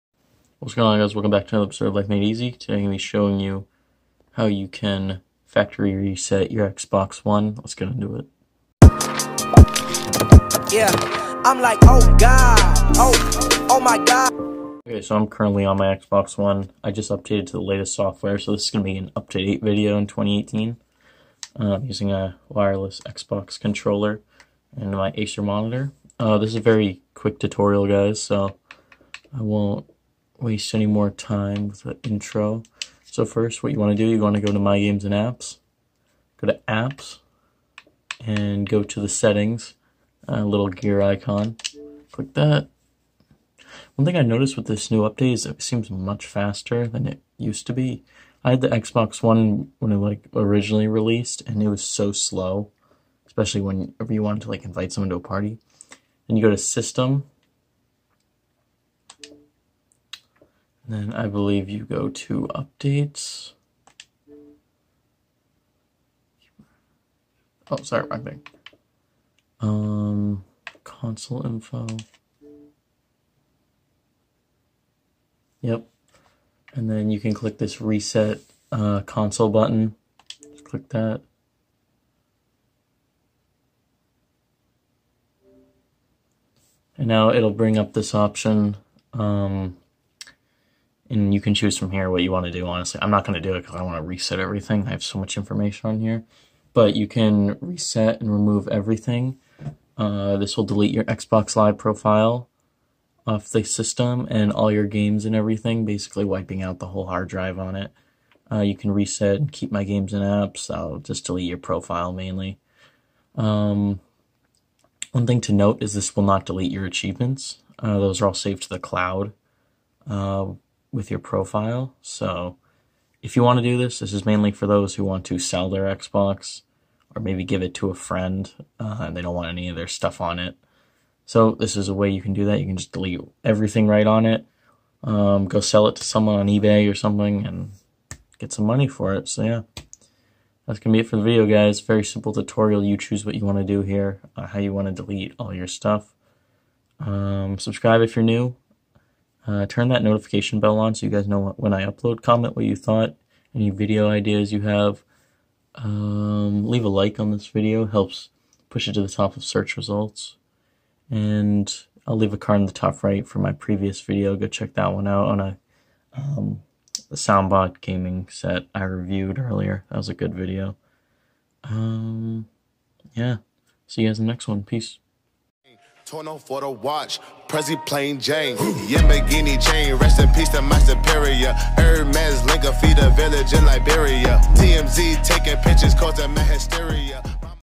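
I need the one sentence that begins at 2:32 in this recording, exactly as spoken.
Comment what you thought, any video ideas you have.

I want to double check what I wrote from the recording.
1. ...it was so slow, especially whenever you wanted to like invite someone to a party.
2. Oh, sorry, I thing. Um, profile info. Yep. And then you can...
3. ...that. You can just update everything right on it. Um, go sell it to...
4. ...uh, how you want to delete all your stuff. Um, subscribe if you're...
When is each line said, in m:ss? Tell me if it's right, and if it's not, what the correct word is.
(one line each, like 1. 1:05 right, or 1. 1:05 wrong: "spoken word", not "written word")
1. 0:51 right
2. 1:07 wrong: "console", not "profile"
3. 2:12 wrong: "delete", not "update"
4. 2:24 right.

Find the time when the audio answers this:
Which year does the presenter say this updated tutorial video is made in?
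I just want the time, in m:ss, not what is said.
0:20.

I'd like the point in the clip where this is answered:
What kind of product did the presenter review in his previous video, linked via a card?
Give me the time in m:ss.
2:47.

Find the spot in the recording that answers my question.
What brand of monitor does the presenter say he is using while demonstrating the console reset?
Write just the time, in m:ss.
0:25.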